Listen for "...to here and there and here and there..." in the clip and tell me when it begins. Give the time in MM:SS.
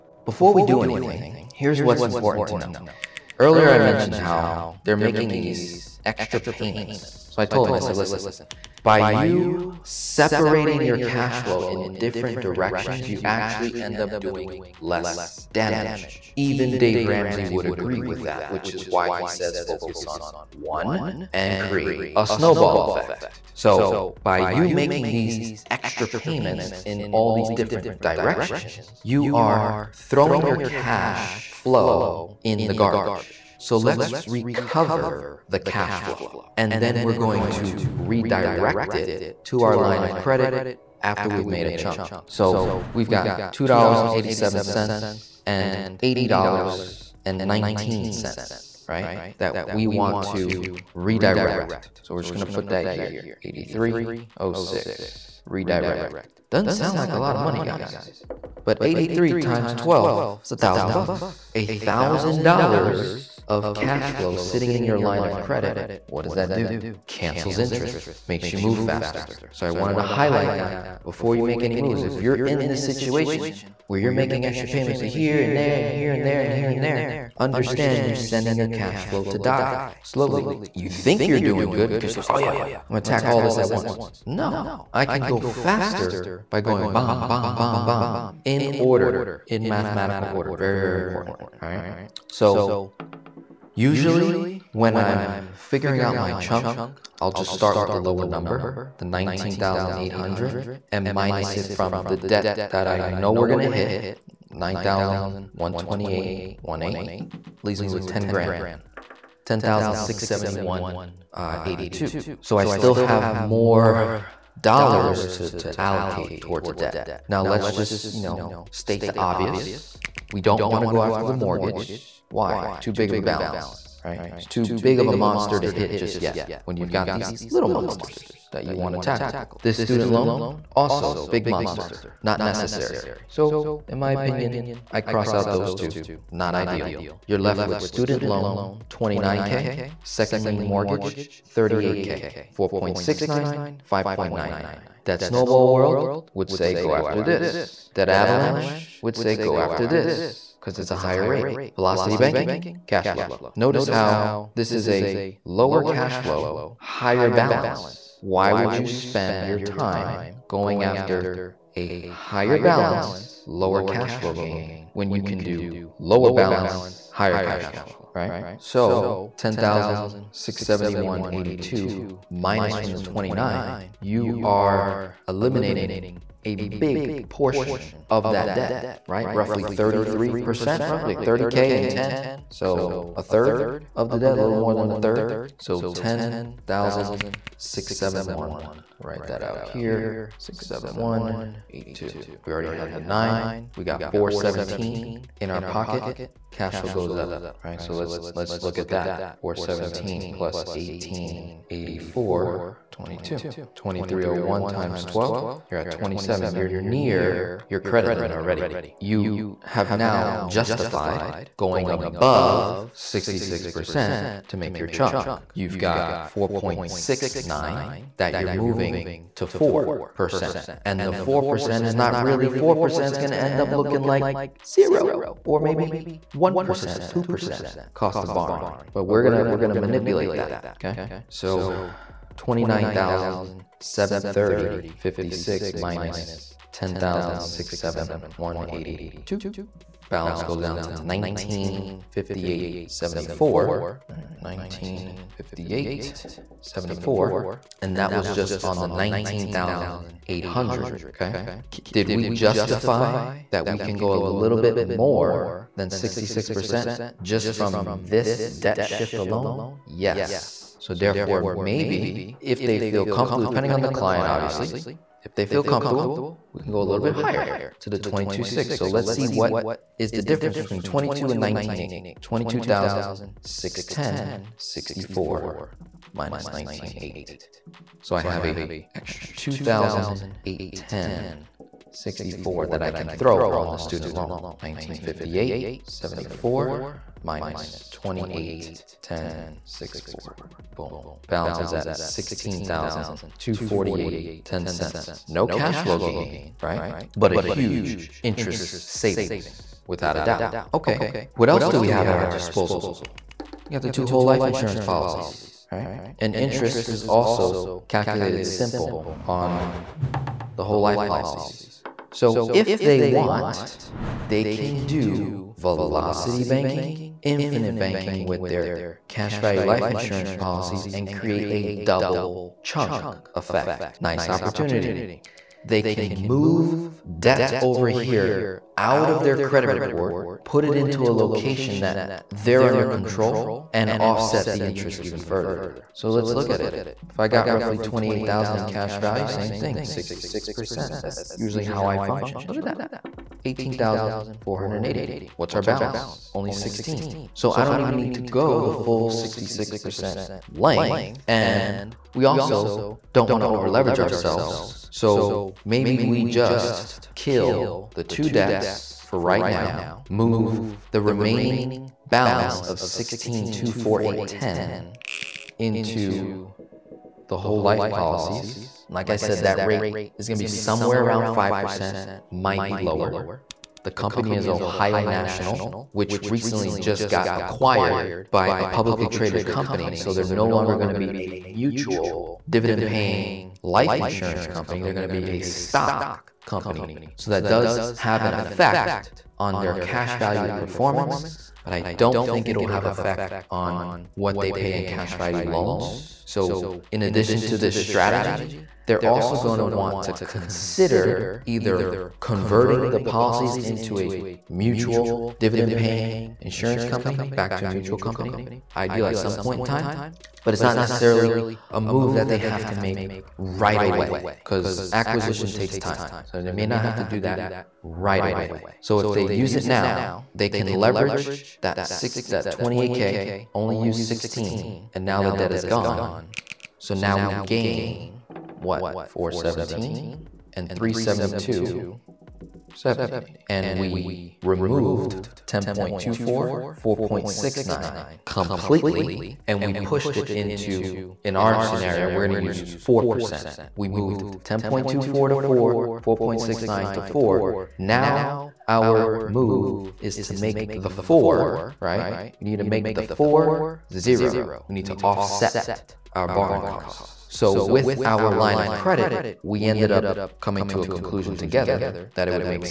01:14.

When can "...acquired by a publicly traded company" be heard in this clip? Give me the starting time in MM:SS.
06:17.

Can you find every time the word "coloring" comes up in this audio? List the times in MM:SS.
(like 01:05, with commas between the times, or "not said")
not said.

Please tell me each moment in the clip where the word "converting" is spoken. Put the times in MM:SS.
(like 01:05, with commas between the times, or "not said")
06:42.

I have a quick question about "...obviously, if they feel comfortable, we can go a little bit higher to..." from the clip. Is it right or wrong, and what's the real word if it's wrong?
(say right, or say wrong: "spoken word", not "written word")
right.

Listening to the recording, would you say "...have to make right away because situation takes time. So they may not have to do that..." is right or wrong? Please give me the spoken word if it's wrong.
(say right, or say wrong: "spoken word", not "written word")
wrong: "acquisition", not "situation".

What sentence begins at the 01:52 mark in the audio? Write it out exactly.
So I still have more dollars to, to allocate towards a debt.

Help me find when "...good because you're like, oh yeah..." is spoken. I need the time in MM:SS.
01:21.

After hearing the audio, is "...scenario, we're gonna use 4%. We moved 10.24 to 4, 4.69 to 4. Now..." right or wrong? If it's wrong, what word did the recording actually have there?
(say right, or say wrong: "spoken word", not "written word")
right.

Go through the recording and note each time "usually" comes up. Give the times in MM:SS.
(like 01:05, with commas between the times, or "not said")
01:33, 05:41.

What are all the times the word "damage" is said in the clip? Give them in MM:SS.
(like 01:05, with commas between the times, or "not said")
00:15.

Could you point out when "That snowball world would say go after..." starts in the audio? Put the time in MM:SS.
02:25.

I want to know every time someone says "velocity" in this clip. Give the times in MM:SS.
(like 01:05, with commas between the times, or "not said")
02:31, 05:15.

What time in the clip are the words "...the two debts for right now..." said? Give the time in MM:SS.
05:57.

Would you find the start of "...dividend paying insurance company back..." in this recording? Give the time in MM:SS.
06:45.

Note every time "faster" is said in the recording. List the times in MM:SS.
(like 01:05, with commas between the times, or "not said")
01:08, 01:25.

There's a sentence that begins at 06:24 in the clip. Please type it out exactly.
They're going to be a stock company.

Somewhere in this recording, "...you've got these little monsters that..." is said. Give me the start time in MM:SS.
02:06.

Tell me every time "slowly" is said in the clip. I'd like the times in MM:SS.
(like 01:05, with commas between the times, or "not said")
01:20.